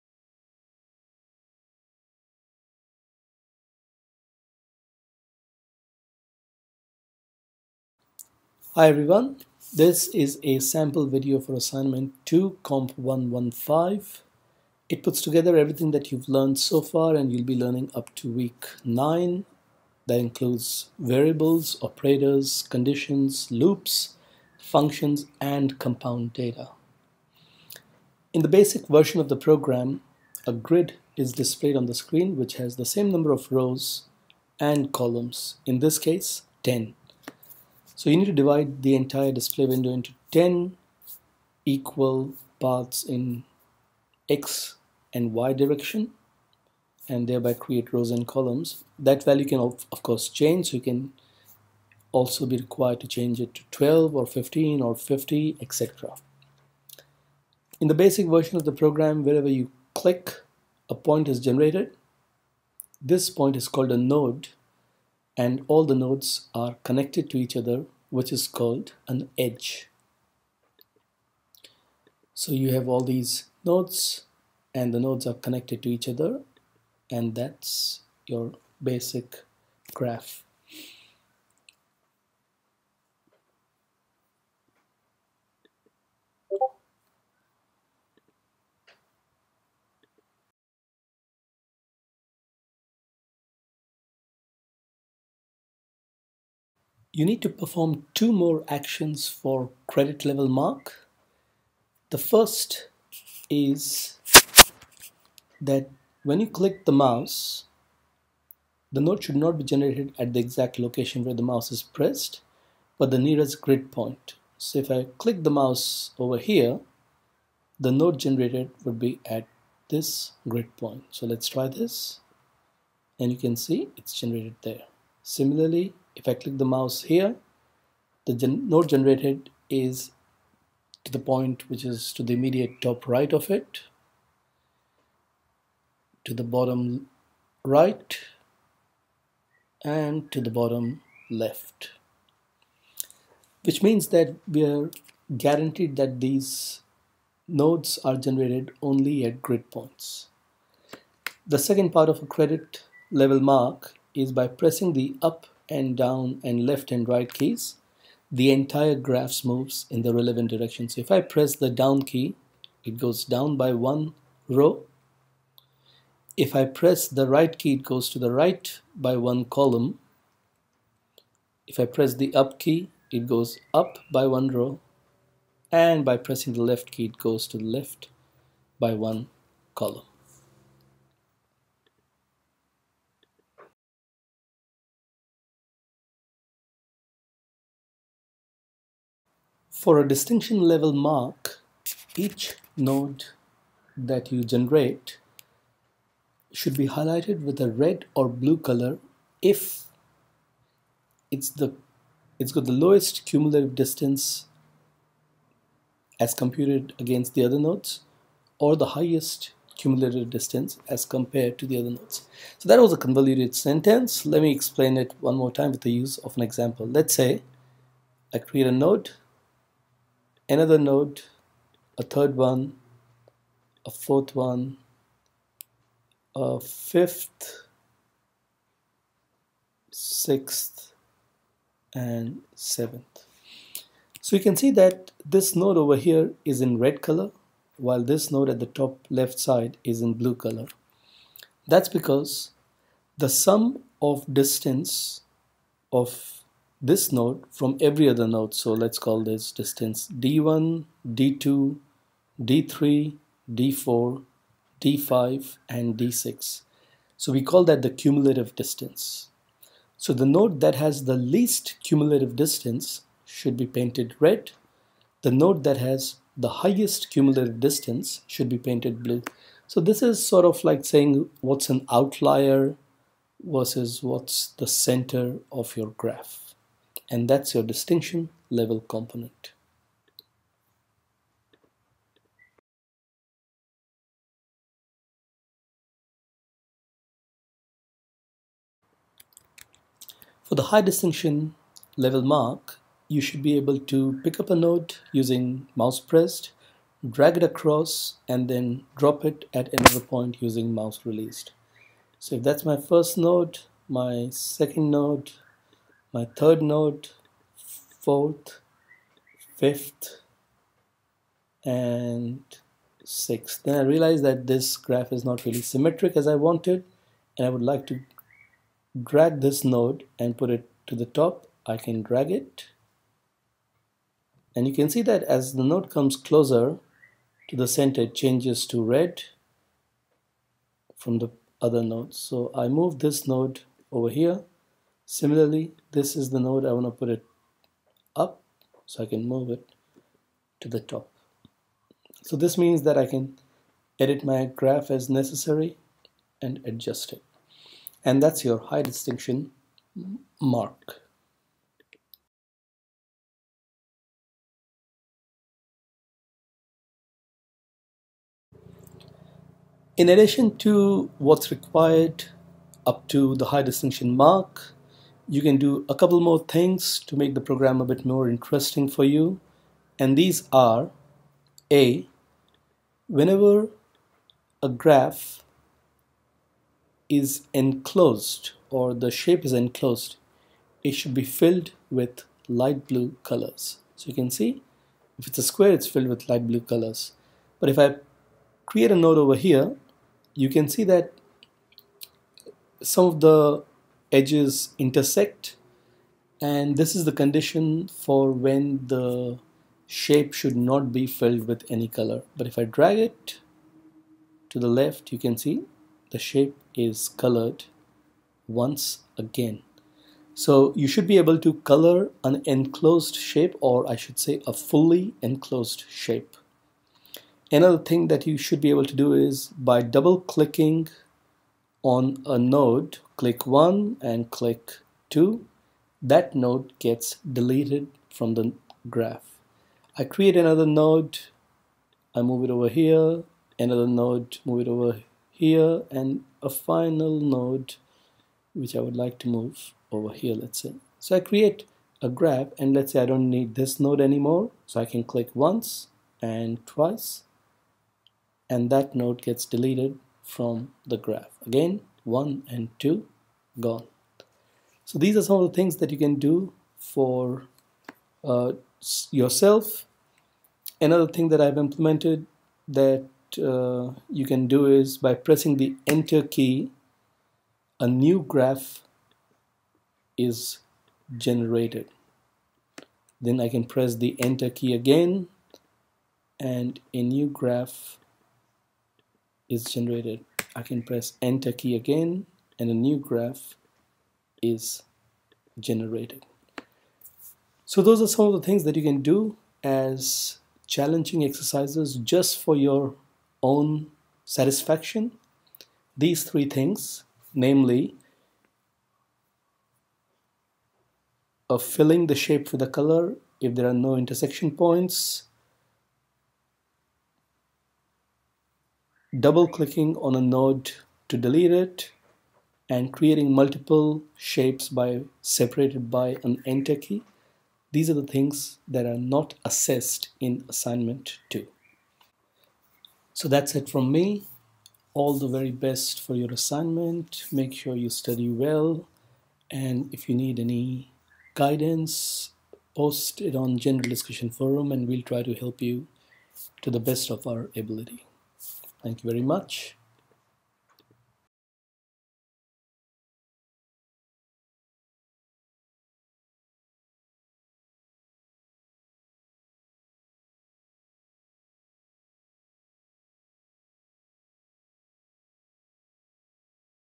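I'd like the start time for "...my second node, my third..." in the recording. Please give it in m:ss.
5:03.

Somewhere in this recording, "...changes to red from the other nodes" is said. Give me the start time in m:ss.
5:28.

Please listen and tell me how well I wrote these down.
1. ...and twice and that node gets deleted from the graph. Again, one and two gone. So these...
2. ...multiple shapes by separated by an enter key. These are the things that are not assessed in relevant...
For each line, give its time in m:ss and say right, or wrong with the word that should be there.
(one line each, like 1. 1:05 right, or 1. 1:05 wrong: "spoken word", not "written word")
1. 7:26 right
2. 8:33 wrong: "assignment", not "relevant".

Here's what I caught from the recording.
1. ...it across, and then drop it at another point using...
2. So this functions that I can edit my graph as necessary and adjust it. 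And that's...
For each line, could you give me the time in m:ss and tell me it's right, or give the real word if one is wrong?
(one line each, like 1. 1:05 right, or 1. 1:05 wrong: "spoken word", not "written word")
1. 4:57 right
2. 5:42 wrong: "means", not "functions".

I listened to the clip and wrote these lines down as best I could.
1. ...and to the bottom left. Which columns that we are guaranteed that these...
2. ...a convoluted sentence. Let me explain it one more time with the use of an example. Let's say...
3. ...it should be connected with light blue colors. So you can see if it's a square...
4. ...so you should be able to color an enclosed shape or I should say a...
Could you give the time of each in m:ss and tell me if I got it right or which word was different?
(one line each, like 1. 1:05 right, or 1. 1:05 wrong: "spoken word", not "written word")
1. 2:19 wrong: "means", not "columns"
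2. 3:32 right
3. 6:20 wrong: "filled", not "connected"
4. 6:50 right.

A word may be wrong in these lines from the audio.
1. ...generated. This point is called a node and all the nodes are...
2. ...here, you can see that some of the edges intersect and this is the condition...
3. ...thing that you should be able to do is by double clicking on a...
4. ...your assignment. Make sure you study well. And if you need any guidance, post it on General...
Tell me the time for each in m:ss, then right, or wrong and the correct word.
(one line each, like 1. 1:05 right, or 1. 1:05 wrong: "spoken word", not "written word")
1. 1:01 right
2. 6:29 right
3. 6:57 right
4. 8:46 right.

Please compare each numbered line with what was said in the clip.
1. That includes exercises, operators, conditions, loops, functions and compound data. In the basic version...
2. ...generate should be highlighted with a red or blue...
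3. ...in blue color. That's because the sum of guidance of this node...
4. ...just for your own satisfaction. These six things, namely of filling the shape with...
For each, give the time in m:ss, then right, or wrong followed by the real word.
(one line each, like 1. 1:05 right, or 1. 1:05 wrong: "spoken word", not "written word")
1. 0:20 wrong: "variables", not "exercises"
2. 3:14 right
3. 4:00 wrong: "distance", not "guidance"
4. 8:11 wrong: "three", not "six".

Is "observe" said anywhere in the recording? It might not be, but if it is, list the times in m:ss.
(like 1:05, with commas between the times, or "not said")
not said.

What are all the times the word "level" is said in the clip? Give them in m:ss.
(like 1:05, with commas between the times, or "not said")
1:40, 2:33, 3:10, 4:38, 4:51.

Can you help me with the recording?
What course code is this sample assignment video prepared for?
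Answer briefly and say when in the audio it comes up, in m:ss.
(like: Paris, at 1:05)
Comp 115, at 0:12.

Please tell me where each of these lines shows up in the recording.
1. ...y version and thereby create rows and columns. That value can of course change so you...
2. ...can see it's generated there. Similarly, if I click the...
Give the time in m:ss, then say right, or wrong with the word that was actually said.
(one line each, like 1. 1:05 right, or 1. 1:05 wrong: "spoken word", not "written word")
1. 0:45 wrong: "direction", not "version"
2. 2:03 right.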